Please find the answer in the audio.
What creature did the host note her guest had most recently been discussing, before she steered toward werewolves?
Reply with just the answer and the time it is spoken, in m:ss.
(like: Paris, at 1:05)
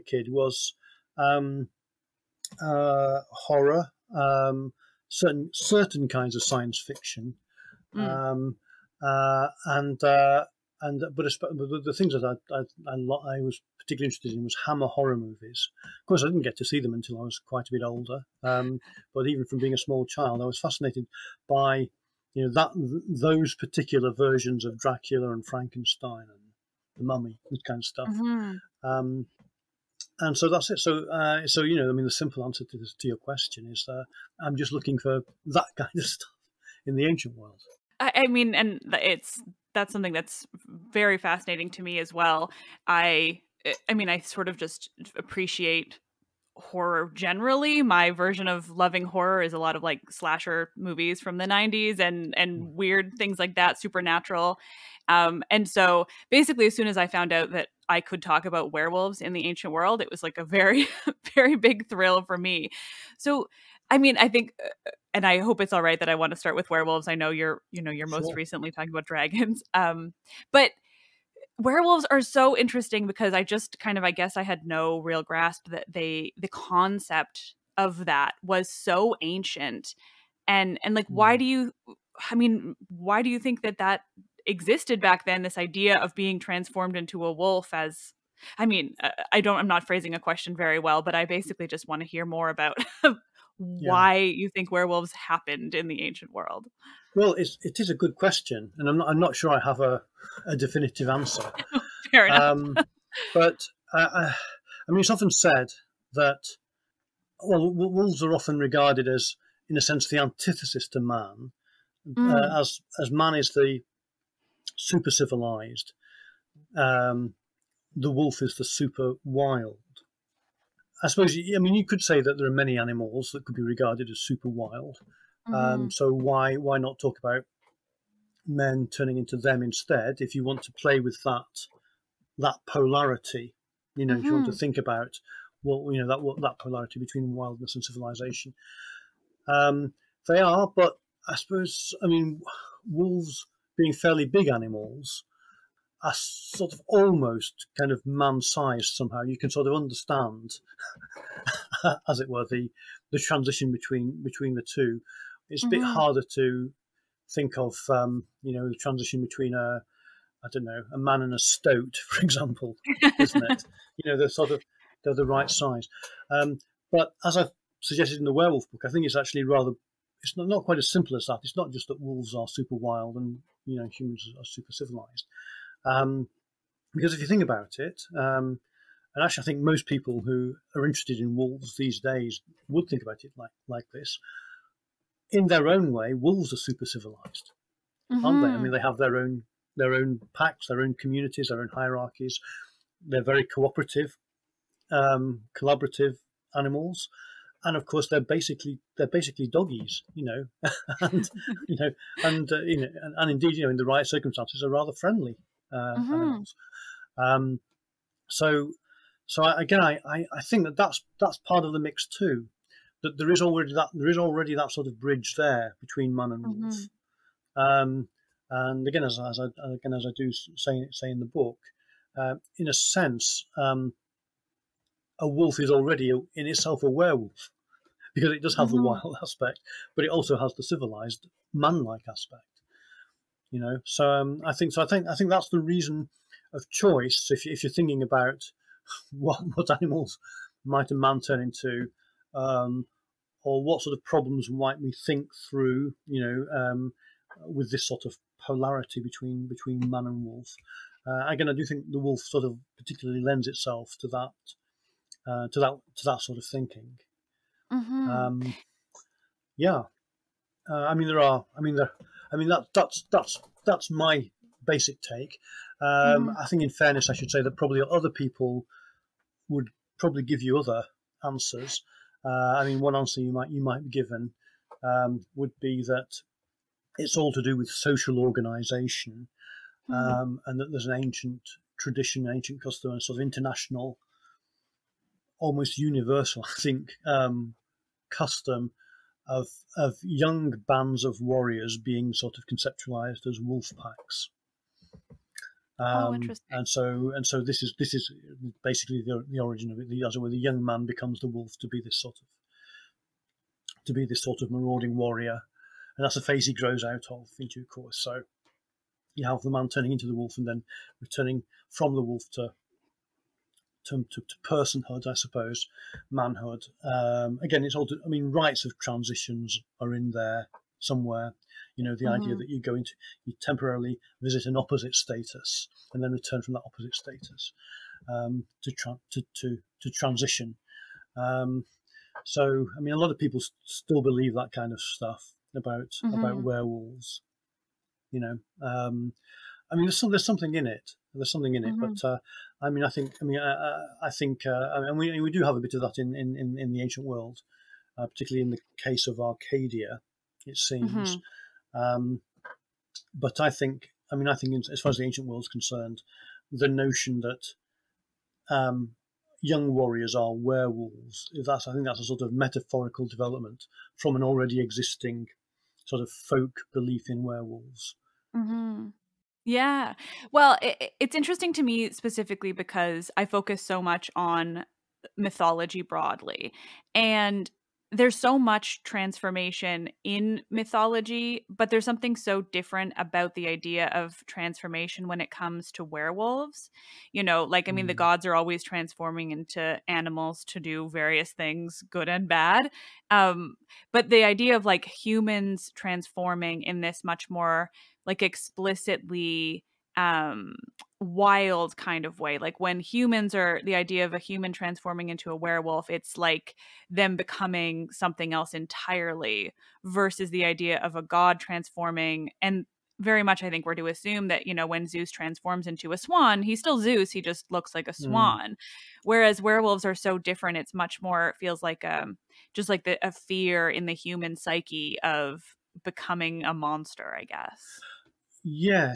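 Dragons, at 1:09.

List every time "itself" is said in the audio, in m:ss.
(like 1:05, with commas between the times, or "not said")
3:46, 4:13.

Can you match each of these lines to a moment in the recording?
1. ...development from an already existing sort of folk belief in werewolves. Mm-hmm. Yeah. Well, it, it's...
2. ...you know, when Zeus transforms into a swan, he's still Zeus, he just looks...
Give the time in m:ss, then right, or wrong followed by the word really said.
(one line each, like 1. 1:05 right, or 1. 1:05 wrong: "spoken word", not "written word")
1. 6:03 right
2. 6:54 right.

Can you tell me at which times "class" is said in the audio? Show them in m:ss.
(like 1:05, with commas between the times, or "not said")
not said.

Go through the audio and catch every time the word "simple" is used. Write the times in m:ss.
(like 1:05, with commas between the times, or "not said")
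0:32, 2:50.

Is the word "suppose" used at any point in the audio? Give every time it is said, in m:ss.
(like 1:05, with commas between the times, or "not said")
2:01, 2:21, 5:15.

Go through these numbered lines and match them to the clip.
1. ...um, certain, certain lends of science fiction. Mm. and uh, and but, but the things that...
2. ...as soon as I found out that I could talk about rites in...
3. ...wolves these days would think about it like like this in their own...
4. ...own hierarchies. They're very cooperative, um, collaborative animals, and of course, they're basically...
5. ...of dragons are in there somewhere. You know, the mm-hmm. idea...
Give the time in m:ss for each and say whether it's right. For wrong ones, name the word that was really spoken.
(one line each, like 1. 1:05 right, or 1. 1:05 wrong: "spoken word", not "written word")
1. 0:04 wrong: "kinds", not "lends"
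2. 0:56 wrong: "werewolves", not "rites"
3. 3:01 right
4. 3:11 right
5. 5:18 wrong: "transitions", not "dragons".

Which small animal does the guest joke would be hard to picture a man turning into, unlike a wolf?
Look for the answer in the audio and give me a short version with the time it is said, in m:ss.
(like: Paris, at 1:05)
A stoat, at 2:41.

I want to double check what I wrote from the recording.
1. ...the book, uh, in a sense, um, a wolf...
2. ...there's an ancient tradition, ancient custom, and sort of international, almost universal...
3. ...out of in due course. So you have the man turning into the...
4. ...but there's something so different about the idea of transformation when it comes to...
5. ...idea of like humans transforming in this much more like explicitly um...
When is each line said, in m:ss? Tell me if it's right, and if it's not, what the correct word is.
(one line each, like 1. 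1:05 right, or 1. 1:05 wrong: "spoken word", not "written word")
1. 3:41 right
2. 4:40 right
3. 5:06 right
4. 6:21 right
5. 6:34 right.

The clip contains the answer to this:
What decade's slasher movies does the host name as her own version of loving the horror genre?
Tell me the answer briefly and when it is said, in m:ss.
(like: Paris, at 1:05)
the 90s, at 0:51.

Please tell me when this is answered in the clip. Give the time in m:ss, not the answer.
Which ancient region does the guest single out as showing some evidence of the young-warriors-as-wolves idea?
5:49.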